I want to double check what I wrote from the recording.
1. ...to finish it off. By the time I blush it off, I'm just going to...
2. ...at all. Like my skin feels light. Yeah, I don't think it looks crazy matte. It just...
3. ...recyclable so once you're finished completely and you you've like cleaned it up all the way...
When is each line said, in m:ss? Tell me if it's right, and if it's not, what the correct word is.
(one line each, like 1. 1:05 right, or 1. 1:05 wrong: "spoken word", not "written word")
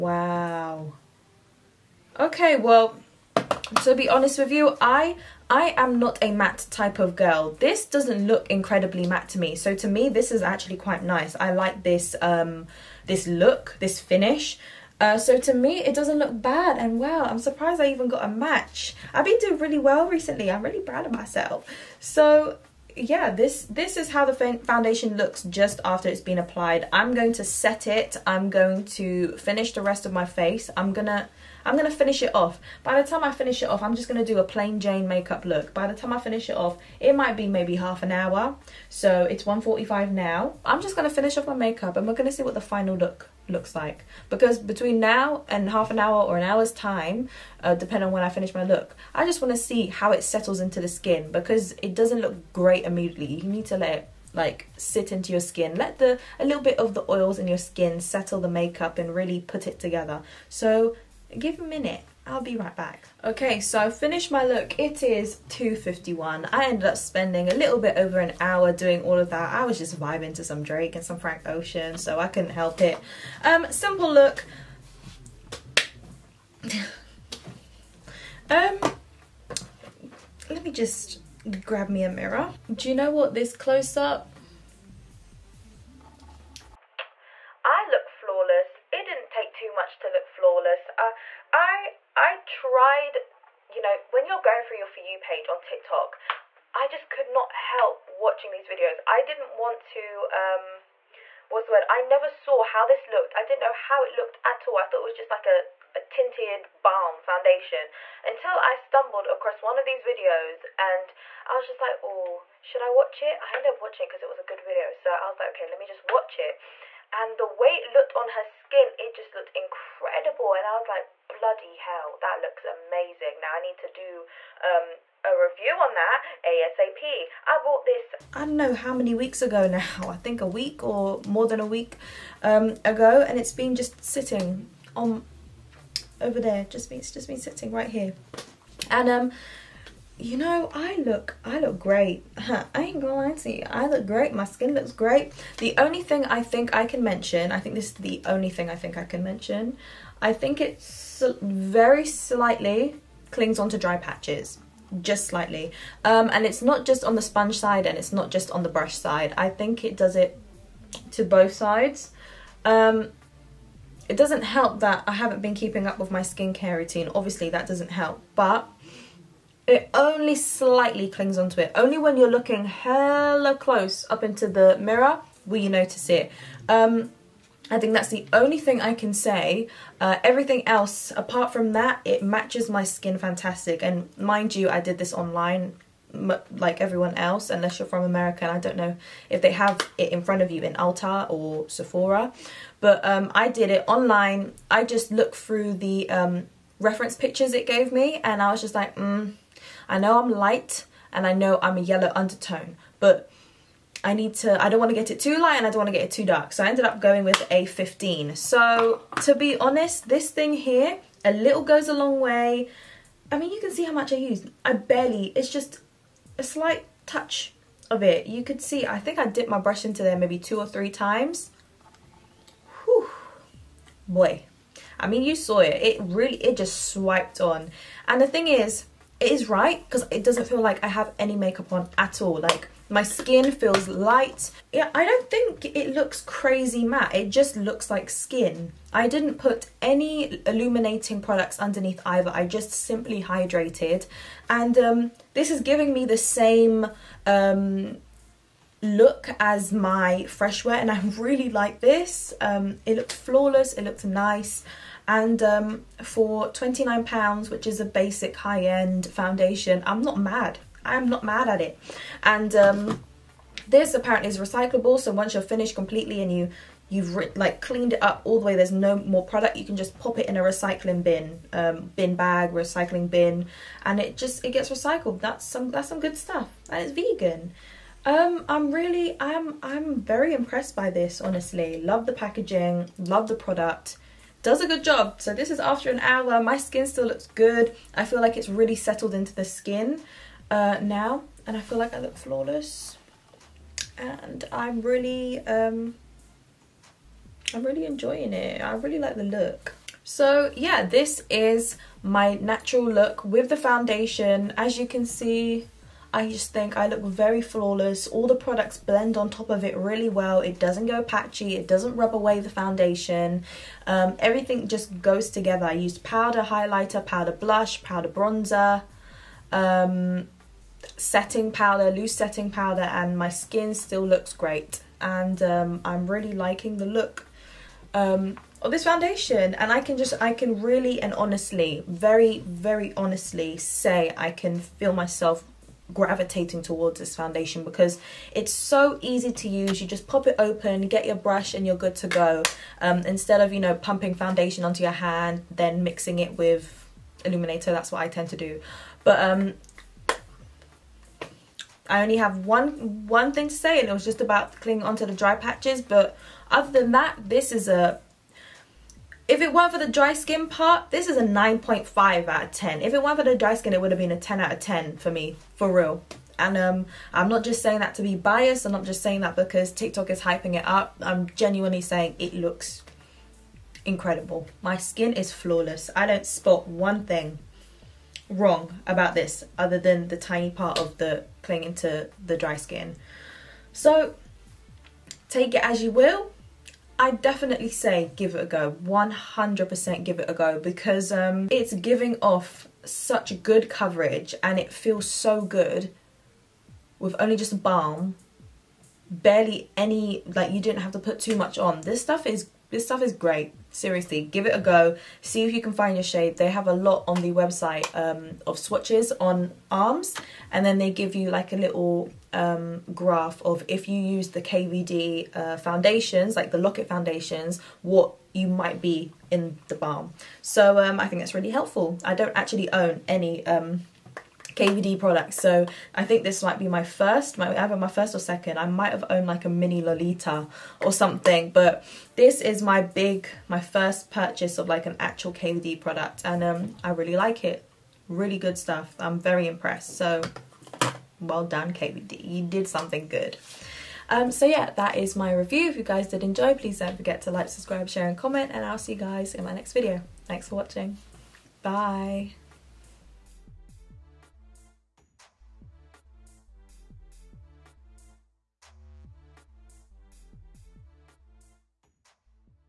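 1. 0:31 wrong: "finish", not "blush"
2. 3:51 right
3. 4:24 right.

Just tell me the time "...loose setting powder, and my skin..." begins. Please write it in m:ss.
5:21.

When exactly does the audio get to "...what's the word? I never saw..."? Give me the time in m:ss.
1:41.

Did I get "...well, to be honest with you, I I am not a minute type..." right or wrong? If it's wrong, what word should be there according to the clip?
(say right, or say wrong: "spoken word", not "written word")
wrong: "matte", not "minute".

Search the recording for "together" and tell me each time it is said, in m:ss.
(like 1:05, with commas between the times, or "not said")
0:59, 5:15.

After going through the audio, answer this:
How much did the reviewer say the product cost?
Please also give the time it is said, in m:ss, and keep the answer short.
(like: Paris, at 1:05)
£29, at 4:16.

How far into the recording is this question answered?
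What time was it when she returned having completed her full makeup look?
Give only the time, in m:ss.
1:05.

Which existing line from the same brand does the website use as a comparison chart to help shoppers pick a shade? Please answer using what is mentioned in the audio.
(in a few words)
Lock-It.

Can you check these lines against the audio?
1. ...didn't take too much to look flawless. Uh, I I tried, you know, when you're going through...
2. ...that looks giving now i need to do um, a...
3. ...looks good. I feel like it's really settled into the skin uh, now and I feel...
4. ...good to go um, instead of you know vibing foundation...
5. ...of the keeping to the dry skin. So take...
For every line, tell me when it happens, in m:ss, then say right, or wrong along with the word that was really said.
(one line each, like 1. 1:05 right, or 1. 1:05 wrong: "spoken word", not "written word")
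1. 1:29 right
2. 2:02 wrong: "amazing", not "giving"
3. 4:47 right
4. 5:41 wrong: "pumping", not "vibing"
5. 6:20 wrong: "clinging", not "keeping".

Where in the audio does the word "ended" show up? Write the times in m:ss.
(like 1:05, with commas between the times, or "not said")
1:06, 1:53, 3:26.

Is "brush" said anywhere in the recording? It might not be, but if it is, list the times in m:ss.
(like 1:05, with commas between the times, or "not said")
2:38, 3:39, 5:41.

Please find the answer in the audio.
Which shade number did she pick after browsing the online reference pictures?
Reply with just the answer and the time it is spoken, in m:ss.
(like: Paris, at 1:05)
15, at 3:27.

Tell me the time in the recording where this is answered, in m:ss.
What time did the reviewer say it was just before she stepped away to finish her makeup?
0:39.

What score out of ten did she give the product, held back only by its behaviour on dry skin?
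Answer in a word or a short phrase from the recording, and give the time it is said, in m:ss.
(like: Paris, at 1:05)
9.5, at 6:01.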